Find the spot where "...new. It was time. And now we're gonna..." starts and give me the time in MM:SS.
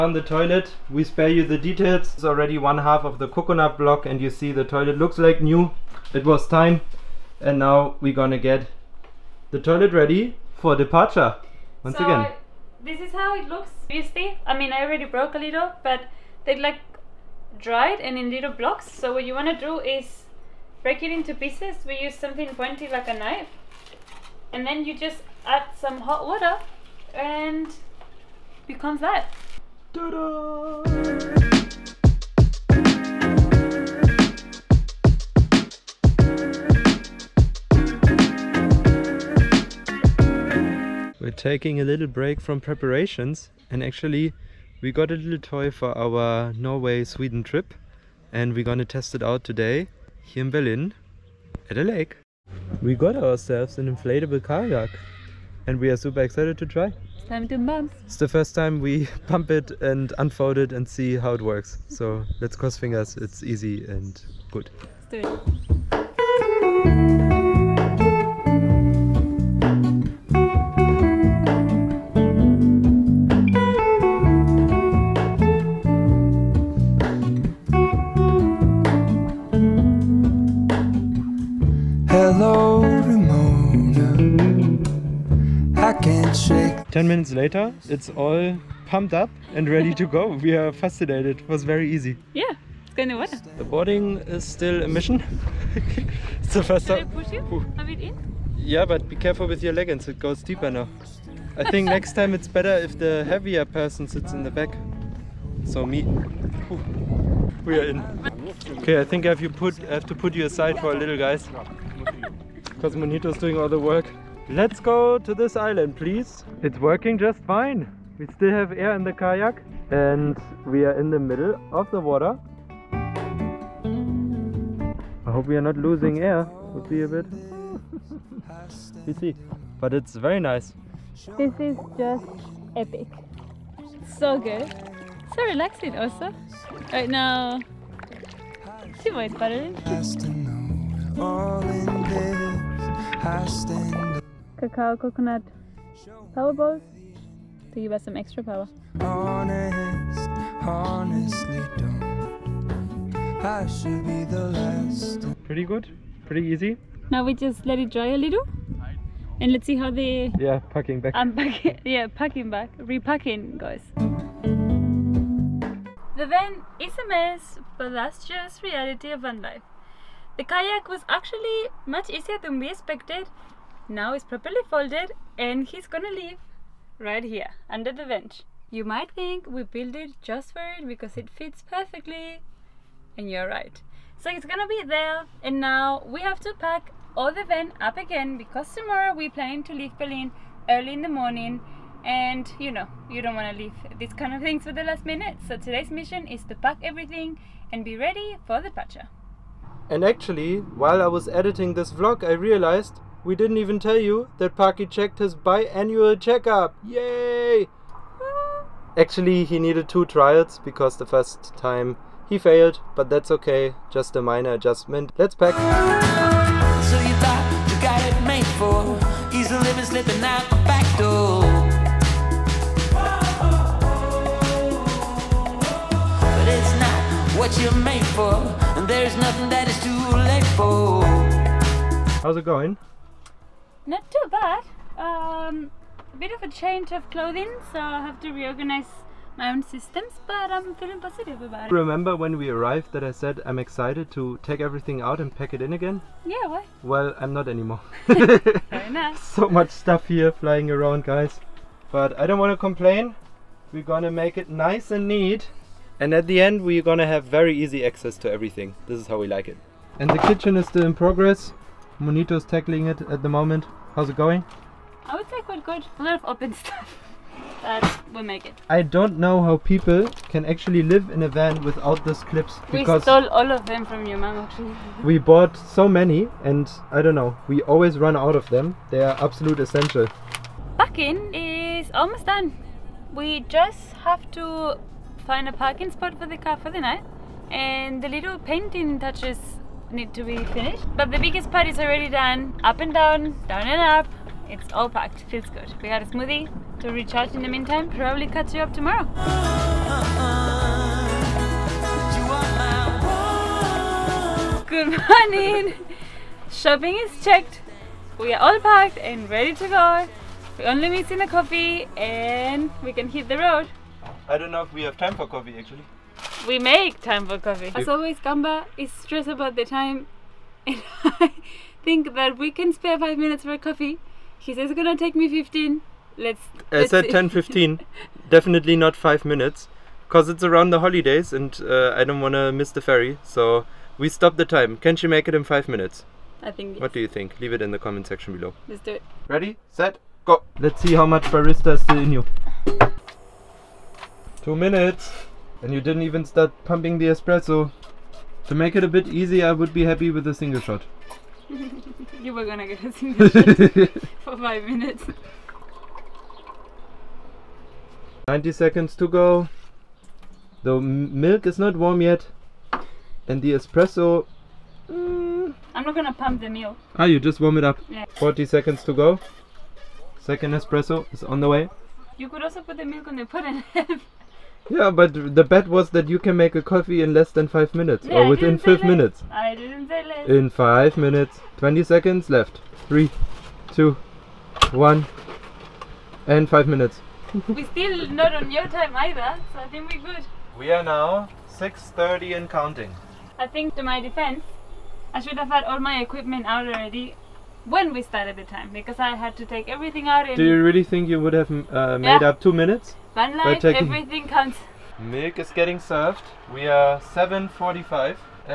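00:05.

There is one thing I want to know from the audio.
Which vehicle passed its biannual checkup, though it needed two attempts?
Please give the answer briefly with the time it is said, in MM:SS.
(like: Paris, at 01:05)
Paki, at 03:24.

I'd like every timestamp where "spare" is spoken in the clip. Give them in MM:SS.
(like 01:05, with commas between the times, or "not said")
00:01, 05:22.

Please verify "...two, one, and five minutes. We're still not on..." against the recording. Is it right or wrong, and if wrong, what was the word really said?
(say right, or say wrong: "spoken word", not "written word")
right.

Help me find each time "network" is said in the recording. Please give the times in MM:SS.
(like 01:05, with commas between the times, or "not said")
not said.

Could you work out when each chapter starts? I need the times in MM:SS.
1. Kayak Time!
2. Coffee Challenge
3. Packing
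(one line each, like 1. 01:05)
1. 00:40
2. 05:17
3. 02:44.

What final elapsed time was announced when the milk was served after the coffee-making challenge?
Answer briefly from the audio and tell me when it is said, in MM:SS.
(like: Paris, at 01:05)
7.45, at 06:46.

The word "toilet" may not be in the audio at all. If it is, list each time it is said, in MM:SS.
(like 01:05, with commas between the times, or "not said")
00:00, 00:04, 00:09.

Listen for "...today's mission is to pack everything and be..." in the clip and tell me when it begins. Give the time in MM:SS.
03:15.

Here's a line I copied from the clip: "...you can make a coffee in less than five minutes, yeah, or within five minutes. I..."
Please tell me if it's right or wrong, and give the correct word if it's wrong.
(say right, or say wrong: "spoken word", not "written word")
right.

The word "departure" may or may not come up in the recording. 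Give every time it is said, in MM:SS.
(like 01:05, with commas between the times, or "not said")
00:10, 03:18.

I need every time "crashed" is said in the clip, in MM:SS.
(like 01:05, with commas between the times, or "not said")
not said.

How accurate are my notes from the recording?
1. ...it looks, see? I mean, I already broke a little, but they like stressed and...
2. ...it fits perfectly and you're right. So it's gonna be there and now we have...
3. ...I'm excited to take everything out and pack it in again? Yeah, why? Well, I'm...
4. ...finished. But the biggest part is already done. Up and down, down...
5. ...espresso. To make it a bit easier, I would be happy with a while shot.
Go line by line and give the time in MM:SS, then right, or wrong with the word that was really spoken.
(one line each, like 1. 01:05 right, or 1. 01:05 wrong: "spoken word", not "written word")
1. 00:13 wrong: "dried", not "stressed"
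2. 03:01 right
3. 04:03 right
4. 04:50 right
5. 05:47 wrong: "single", not "while".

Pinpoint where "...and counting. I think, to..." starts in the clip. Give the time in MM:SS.
06:32.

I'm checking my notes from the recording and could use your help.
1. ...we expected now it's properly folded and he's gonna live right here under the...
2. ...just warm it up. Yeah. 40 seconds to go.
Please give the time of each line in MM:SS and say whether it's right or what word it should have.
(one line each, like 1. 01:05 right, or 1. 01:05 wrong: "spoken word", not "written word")
1. 02:52 right
2. 06:07 right.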